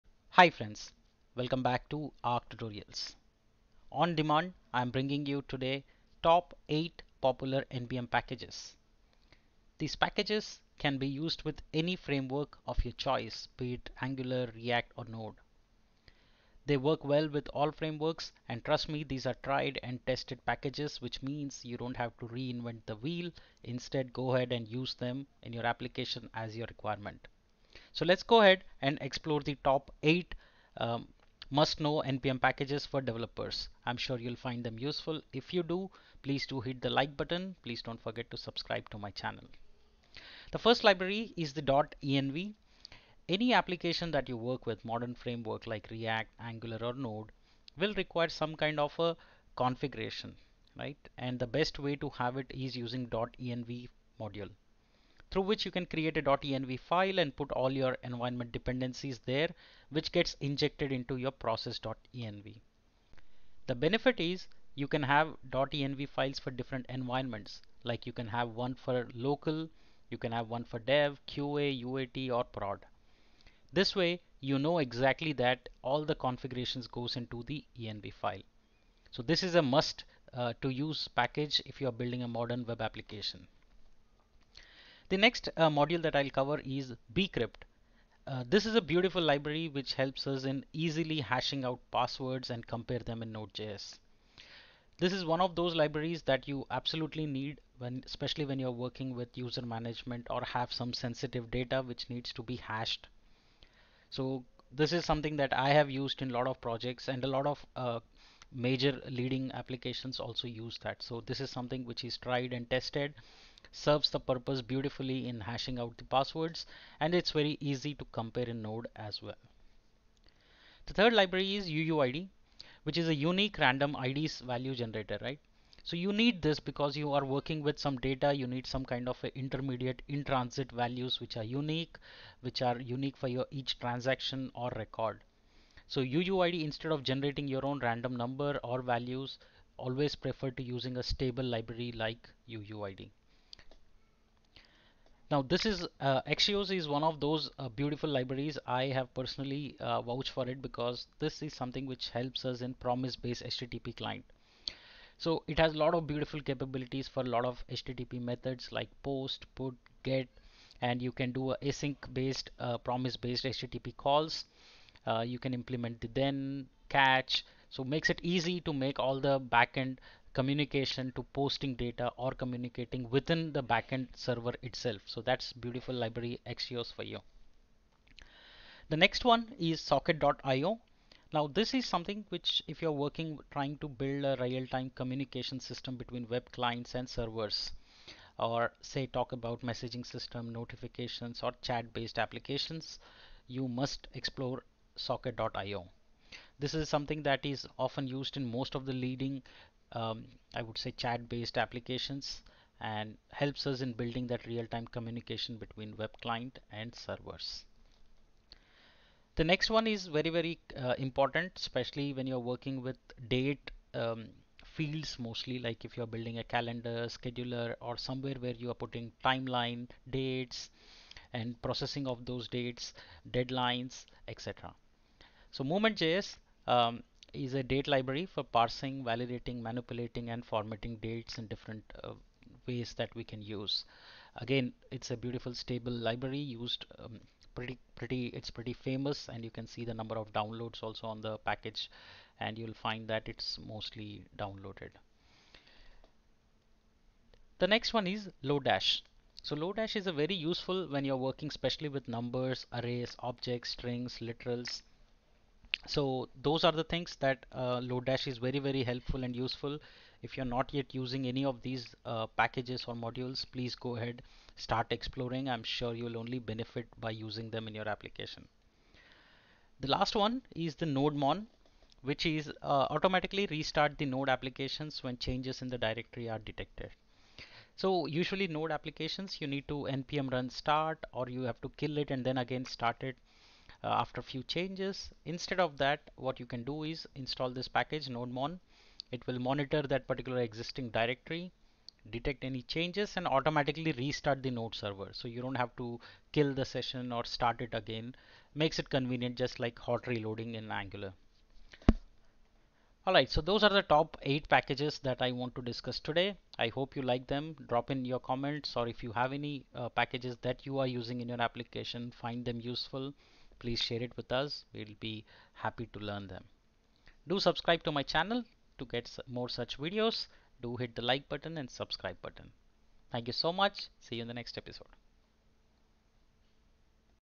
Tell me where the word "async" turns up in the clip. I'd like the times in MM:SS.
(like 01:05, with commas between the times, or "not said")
02:41.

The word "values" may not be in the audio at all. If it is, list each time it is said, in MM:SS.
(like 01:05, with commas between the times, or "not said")
02:04, 02:10, 02:18.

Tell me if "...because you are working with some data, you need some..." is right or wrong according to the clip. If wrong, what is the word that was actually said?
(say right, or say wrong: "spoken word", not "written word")
right.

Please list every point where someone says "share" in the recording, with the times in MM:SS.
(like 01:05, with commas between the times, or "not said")
05:13.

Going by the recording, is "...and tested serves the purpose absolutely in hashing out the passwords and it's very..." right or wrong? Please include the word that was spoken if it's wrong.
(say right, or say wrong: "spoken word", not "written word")
wrong: "beautifully", not "absolutely".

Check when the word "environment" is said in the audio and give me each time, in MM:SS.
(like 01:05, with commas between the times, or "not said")
00:58, 01:06.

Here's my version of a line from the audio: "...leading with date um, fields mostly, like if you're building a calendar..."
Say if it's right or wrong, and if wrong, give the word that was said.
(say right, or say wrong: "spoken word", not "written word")
wrong: "working", not "leading".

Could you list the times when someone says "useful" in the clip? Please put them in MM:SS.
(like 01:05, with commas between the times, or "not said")
00:34, 04:10, 04:19, 05:12.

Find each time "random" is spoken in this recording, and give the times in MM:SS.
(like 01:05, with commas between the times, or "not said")
02:03, 02:17.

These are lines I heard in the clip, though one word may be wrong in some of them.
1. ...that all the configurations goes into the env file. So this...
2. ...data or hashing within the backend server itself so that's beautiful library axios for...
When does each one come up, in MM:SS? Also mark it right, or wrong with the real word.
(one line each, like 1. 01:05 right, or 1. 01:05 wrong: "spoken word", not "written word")
1. 01:15 right
2. 02:51 wrong: "communicating", not "hashing".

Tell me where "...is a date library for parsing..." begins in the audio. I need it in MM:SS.
03:47.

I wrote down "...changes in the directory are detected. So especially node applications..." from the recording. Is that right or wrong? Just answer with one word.
wrong.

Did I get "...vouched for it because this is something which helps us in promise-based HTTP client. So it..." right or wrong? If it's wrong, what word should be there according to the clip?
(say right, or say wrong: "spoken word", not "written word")
right.